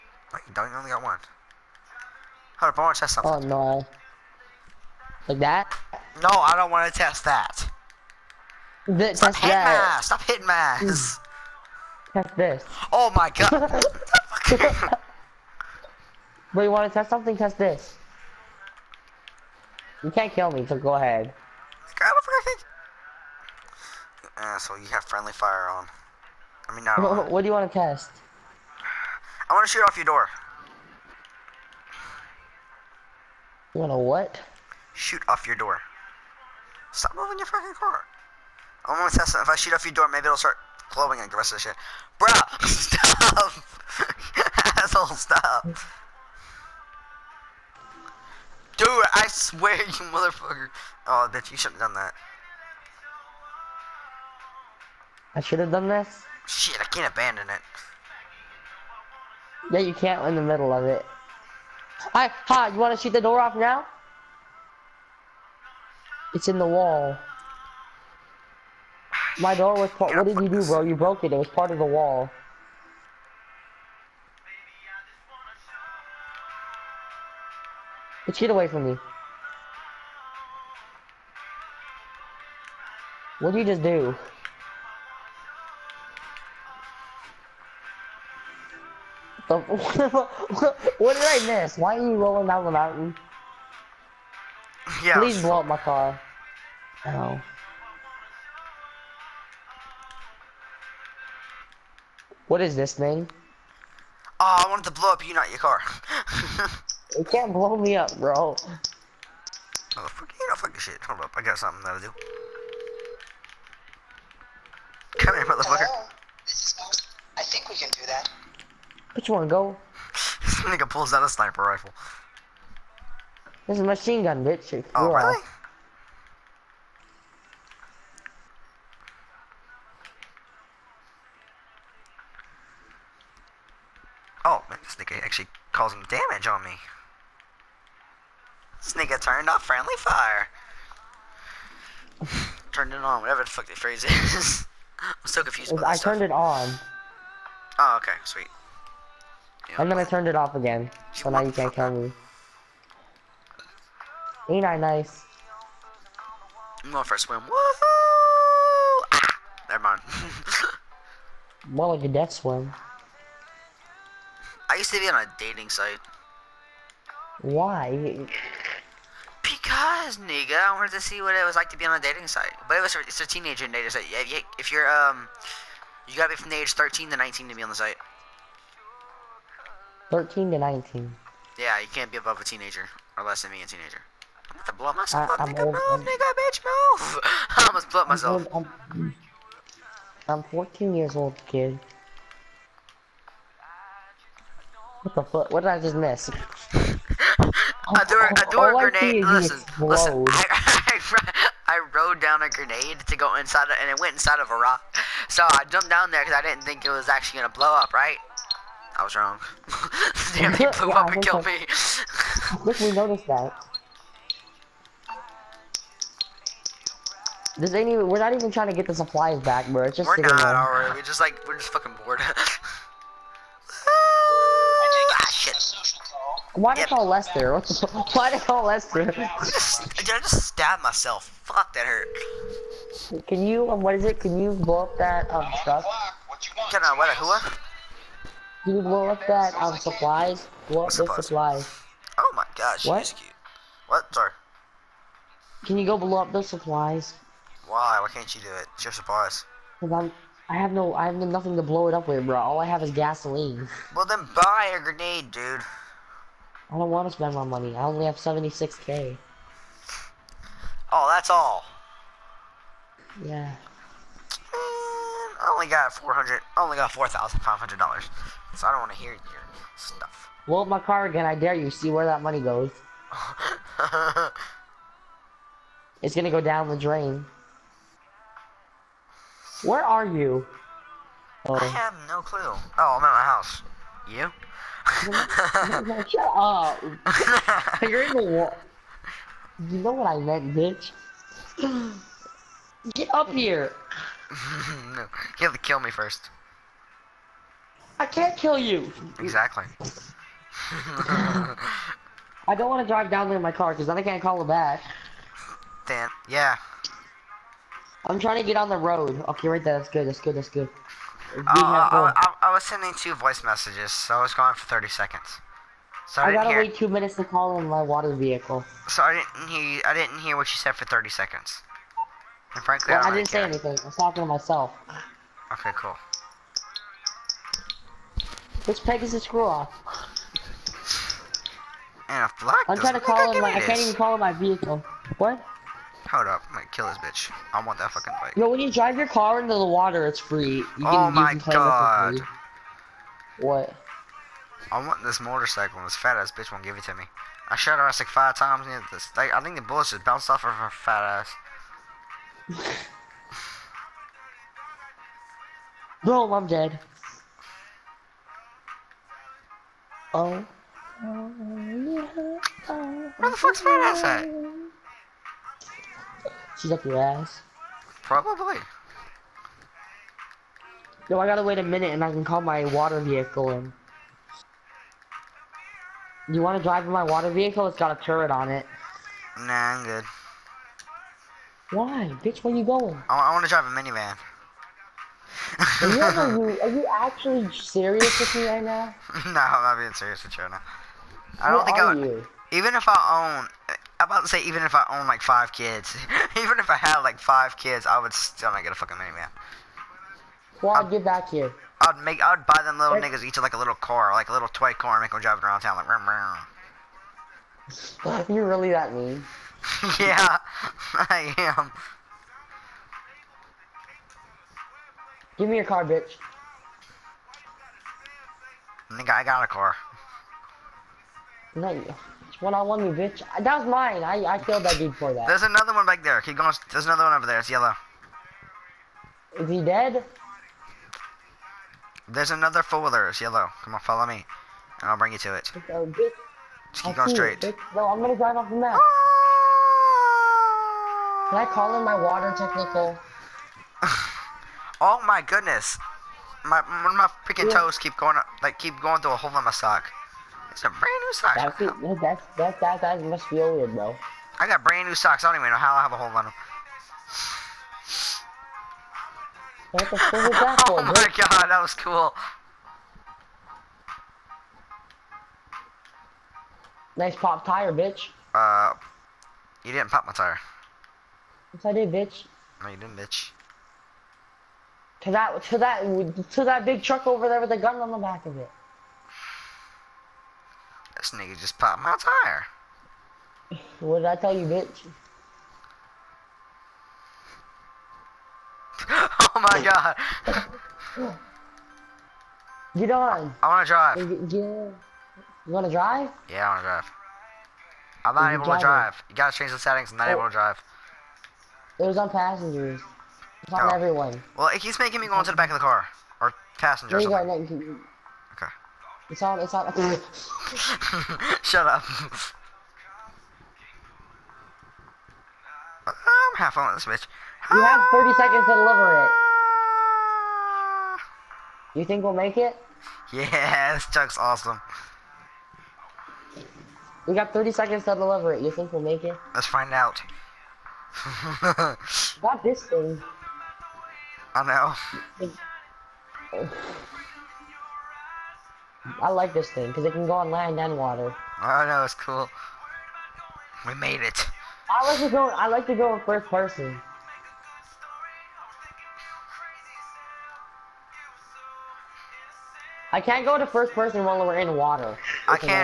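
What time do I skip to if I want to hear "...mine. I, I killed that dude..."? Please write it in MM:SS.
07:03.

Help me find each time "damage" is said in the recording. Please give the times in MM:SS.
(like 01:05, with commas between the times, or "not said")
02:16.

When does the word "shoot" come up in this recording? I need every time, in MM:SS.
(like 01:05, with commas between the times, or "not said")
00:29, 00:34, 00:39, 01:02.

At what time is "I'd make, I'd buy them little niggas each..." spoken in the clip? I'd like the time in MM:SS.
06:41.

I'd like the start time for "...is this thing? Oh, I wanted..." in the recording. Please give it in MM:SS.
01:42.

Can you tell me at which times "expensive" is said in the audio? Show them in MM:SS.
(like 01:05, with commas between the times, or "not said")
not said.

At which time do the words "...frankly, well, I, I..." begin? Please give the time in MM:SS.
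05:22.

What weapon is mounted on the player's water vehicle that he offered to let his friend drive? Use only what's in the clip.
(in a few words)
turret.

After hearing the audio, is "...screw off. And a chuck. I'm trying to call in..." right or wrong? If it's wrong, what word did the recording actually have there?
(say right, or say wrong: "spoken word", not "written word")
wrong: "black", not "chuck".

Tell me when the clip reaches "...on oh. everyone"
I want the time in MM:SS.
08:23.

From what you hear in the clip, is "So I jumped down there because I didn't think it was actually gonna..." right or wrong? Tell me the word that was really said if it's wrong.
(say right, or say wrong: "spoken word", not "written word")
right.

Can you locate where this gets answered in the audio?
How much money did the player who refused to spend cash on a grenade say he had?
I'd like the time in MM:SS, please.
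04:18.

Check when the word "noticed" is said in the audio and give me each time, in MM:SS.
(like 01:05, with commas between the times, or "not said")
03:32.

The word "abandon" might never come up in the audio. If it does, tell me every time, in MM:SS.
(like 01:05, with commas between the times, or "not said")
00:57.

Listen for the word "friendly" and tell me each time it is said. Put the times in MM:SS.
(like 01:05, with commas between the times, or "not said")
00:25, 02:19.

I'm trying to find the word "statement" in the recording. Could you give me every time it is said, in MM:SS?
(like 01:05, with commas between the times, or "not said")
not said.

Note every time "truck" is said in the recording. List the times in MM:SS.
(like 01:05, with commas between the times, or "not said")
03:55, 07:56.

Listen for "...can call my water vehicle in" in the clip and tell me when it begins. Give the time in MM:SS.
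06:12.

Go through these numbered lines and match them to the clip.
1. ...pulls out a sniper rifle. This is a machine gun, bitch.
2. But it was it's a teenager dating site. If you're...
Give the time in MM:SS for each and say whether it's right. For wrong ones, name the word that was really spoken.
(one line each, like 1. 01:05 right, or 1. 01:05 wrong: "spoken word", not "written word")
1. 02:00 right
2. 02:52 right.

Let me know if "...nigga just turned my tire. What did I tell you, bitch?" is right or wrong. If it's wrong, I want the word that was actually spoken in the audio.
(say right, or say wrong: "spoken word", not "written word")
wrong: "popped", not "turned".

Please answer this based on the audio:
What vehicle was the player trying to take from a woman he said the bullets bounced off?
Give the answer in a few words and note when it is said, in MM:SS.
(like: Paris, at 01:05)
motorcycle, at 05:45.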